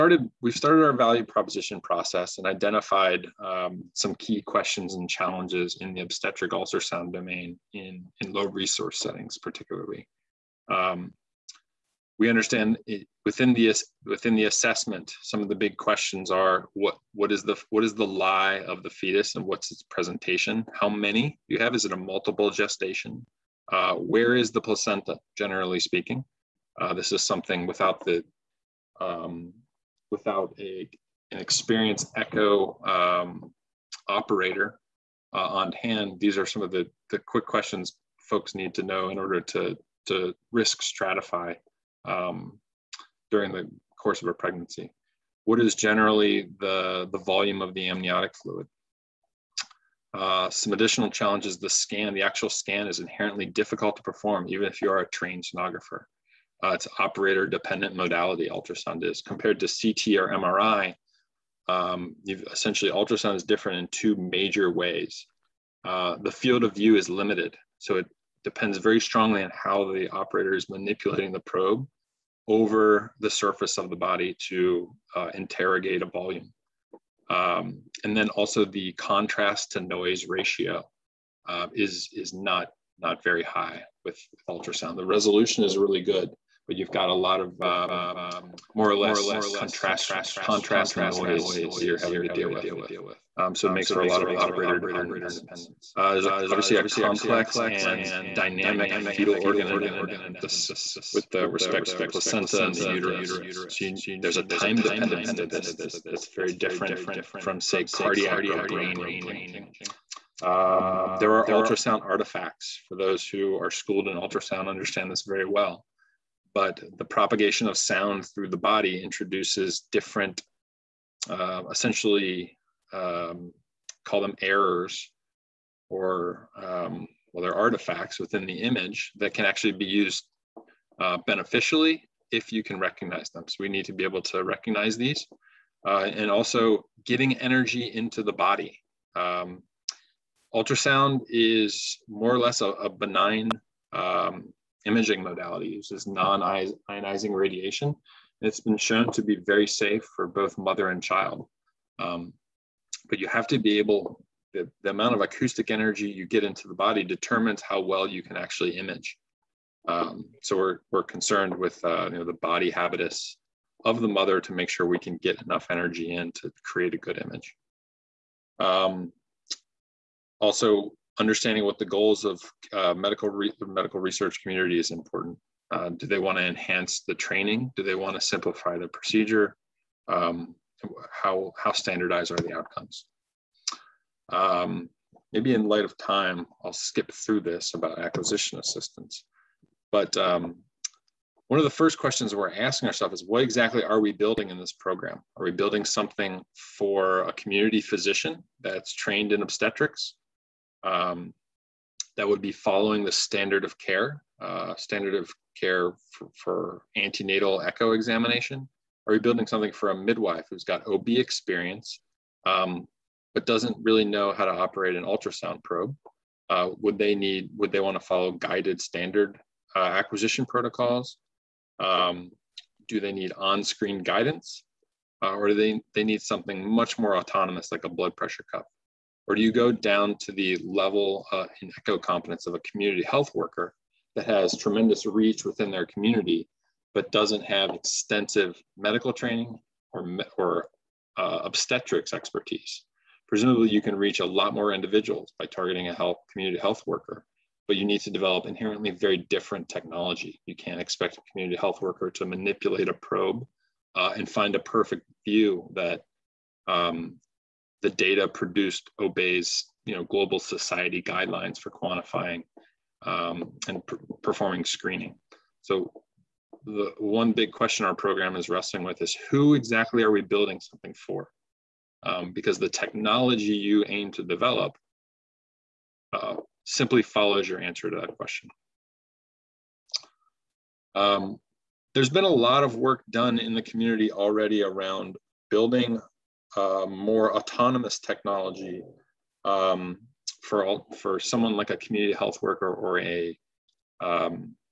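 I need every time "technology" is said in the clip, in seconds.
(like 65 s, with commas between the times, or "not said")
249 s, 272 s, 287 s.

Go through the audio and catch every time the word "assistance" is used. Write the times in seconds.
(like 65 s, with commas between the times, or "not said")
188 s.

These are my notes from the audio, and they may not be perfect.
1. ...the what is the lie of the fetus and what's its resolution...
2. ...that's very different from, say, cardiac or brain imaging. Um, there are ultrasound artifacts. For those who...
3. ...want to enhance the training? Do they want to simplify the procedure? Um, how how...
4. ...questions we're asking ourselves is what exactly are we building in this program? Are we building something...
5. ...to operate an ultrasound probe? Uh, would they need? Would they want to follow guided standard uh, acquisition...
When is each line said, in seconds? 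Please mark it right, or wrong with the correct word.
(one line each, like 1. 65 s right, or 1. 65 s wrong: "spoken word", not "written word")
1. 17 s wrong: "presentation", not "resolution"
2. 106 s right
3. 176 s right
4. 191 s right
5. 214 s right.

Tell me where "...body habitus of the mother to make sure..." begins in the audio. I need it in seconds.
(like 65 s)
162 s.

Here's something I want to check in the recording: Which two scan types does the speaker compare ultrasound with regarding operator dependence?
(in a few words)
CT or MRI.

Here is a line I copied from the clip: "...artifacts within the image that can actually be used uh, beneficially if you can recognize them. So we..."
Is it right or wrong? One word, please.
right.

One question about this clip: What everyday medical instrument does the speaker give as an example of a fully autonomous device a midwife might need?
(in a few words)
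blood pressure cuff.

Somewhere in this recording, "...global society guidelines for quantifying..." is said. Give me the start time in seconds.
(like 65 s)
260 s.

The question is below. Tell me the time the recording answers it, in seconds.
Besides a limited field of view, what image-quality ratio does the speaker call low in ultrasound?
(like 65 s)
78 s.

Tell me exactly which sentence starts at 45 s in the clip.
What is generally the, the volume of the amniotic fluid?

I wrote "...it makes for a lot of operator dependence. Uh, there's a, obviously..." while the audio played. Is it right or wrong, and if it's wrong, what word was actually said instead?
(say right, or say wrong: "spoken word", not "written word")
right.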